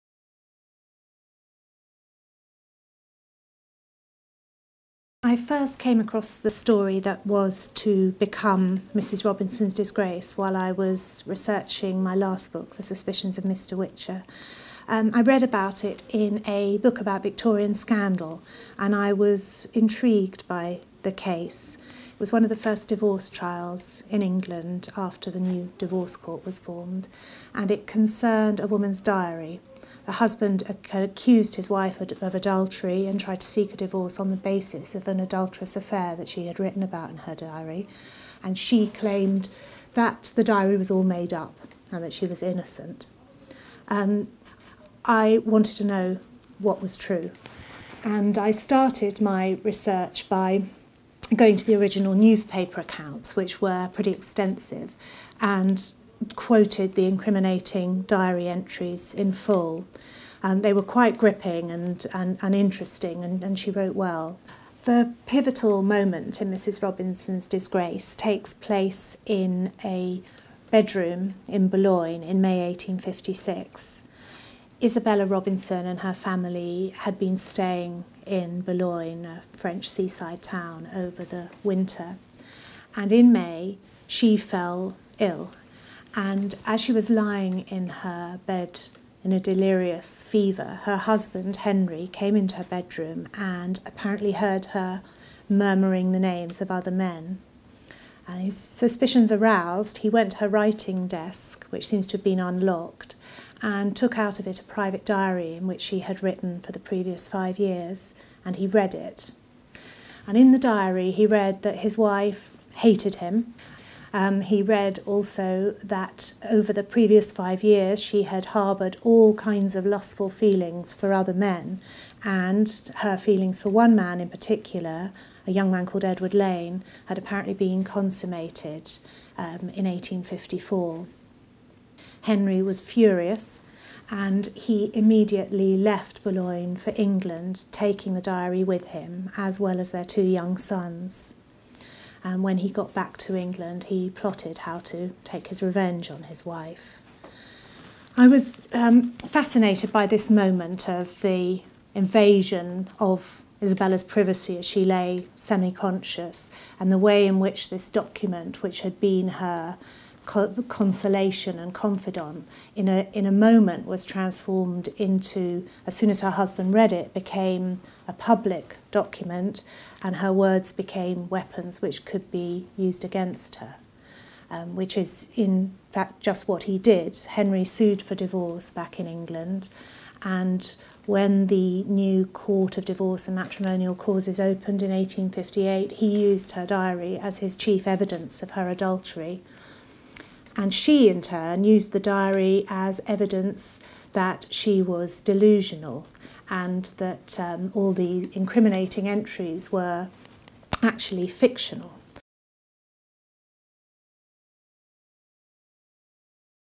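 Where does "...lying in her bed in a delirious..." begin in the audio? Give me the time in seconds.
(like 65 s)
87 s.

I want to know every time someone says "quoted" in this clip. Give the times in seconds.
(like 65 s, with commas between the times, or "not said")
56 s.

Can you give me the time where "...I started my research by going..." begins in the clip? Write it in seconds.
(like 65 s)
48 s.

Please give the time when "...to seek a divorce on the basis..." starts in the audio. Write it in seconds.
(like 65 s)
33 s.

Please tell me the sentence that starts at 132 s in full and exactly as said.
Henry was furious and he immediately left Boulogne for England, taking the diary with him, as well as their two young sons.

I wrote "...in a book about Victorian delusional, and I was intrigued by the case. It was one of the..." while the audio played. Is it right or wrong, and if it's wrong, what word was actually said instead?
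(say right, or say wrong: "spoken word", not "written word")
wrong: "scandal", not "delusional".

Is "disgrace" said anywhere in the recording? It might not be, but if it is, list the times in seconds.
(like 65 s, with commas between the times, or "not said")
9 s, 67 s.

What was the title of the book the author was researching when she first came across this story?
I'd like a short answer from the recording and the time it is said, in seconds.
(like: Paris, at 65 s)
The Suspicions of Mr. Witcher, at 12 s.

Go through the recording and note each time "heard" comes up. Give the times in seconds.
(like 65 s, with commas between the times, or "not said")
94 s.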